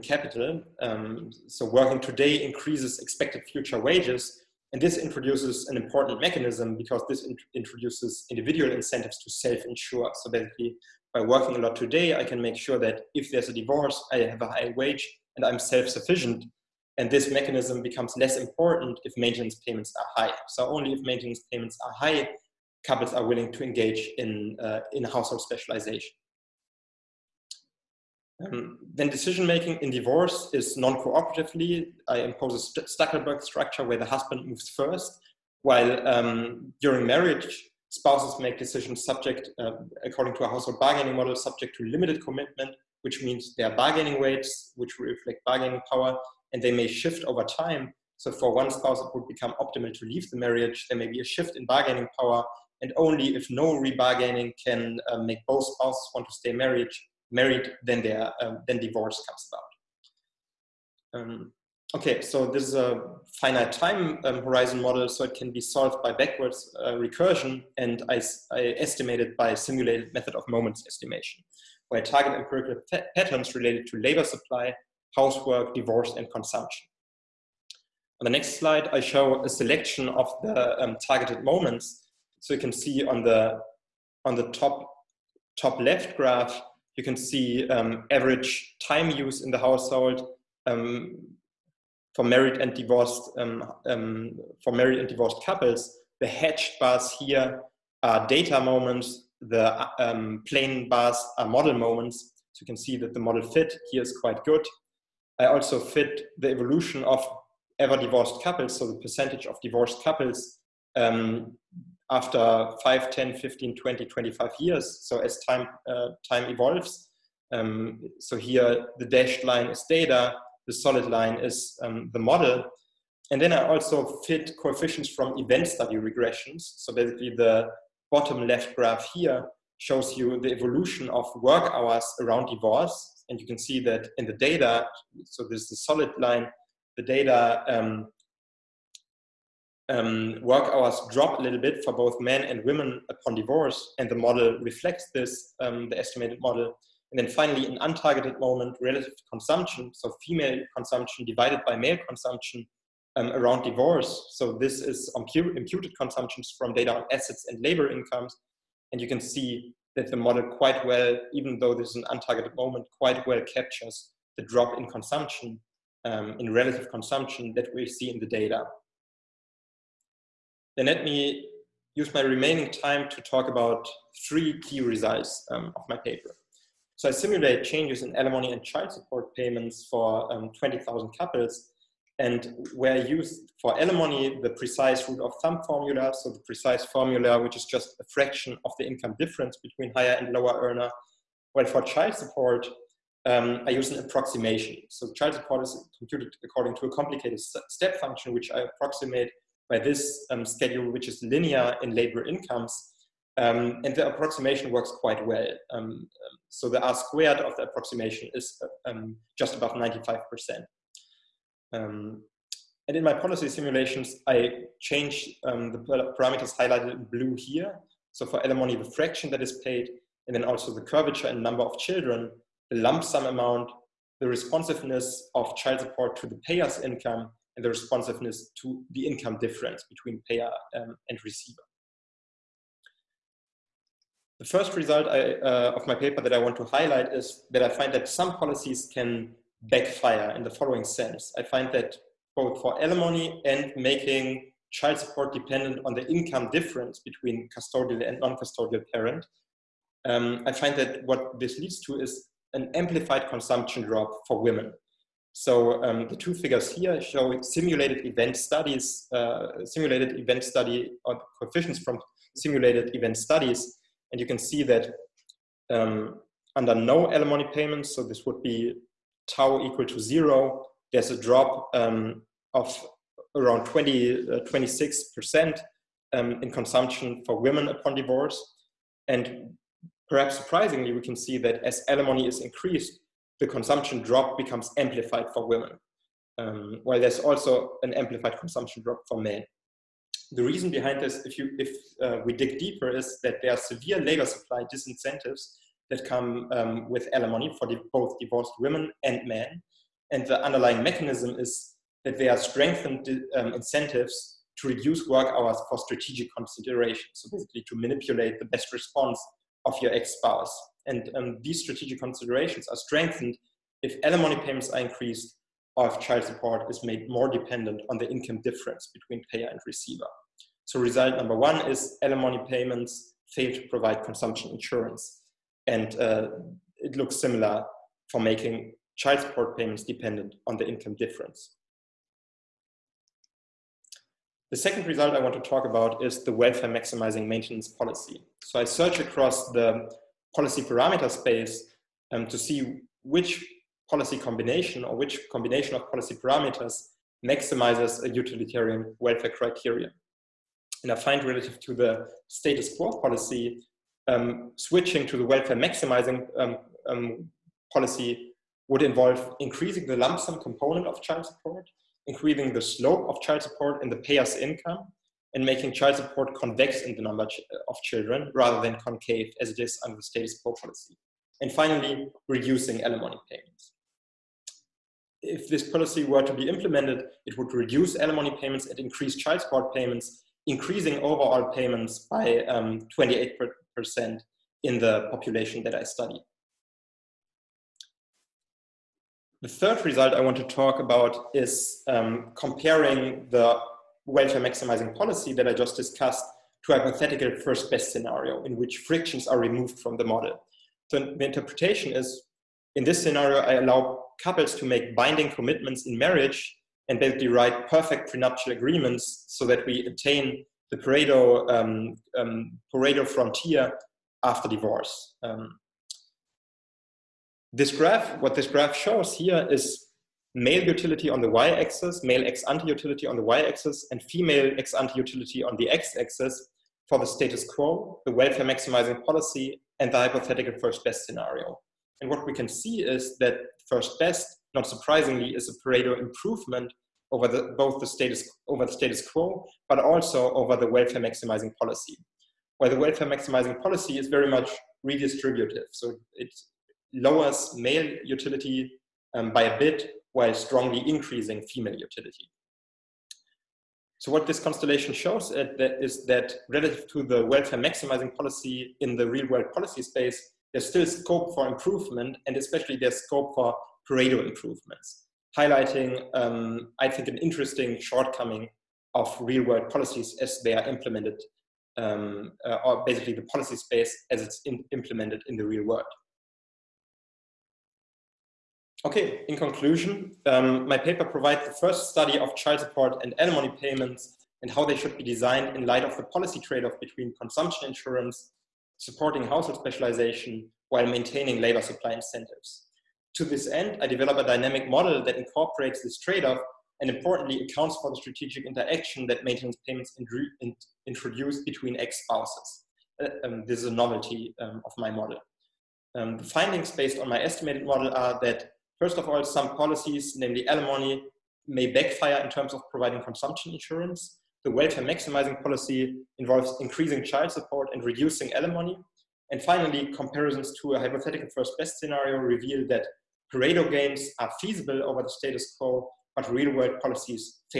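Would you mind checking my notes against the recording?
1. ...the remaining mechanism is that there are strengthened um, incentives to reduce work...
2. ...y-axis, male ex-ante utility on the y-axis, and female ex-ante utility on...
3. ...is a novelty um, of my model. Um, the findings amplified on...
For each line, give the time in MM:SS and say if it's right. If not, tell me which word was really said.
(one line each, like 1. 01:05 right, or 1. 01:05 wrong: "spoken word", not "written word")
1. 05:00 wrong: "underlying", not "remaining"
2. 07:01 right
3. 08:23 wrong: "based", not "amplified".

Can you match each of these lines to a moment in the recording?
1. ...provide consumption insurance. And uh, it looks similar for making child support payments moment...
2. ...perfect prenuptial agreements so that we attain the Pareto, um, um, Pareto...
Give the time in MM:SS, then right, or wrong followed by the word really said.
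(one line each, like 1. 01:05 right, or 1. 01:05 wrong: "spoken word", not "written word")
1. 05:23 wrong: "dependent", not "moment"
2. 06:47 right.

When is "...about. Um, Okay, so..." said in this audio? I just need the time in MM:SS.
00:59.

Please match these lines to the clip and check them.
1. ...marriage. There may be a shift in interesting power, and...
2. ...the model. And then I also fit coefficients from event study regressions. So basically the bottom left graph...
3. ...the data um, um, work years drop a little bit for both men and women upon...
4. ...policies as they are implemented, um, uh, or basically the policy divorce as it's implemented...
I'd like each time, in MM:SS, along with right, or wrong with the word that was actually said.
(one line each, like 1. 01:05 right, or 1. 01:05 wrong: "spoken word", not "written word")
1. 00:50 wrong: "bargaining", not "interesting"
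2. 02:02 right
3. 02:16 wrong: "hours", not "years"
4. 07:49 wrong: "space", not "divorce".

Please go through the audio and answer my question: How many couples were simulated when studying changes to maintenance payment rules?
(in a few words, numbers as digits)
20,000.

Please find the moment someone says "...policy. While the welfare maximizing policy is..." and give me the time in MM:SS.
07:21.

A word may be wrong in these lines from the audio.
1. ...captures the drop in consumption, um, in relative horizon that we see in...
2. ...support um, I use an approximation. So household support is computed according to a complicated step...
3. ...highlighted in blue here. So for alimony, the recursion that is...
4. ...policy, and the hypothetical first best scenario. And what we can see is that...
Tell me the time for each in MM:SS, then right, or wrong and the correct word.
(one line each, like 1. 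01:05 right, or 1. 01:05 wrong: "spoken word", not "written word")
1. 02:43 wrong: "consumption", not "horizon"
2. 03:12 wrong: "child", not "household"
3. 03:36 wrong: "fraction", not "recursion"
4. 07:09 right.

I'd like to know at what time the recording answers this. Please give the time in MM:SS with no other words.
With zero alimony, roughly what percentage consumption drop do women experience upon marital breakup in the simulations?
04:34.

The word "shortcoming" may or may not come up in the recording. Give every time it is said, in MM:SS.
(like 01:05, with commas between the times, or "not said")
07:47.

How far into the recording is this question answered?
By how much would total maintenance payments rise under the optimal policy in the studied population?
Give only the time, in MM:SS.
06:22.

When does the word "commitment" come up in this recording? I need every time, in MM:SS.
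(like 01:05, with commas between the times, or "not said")
00:42, 06:45.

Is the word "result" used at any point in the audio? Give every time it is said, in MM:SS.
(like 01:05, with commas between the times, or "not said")
02:54, 03:54, 05:20, 05:34, 06:29.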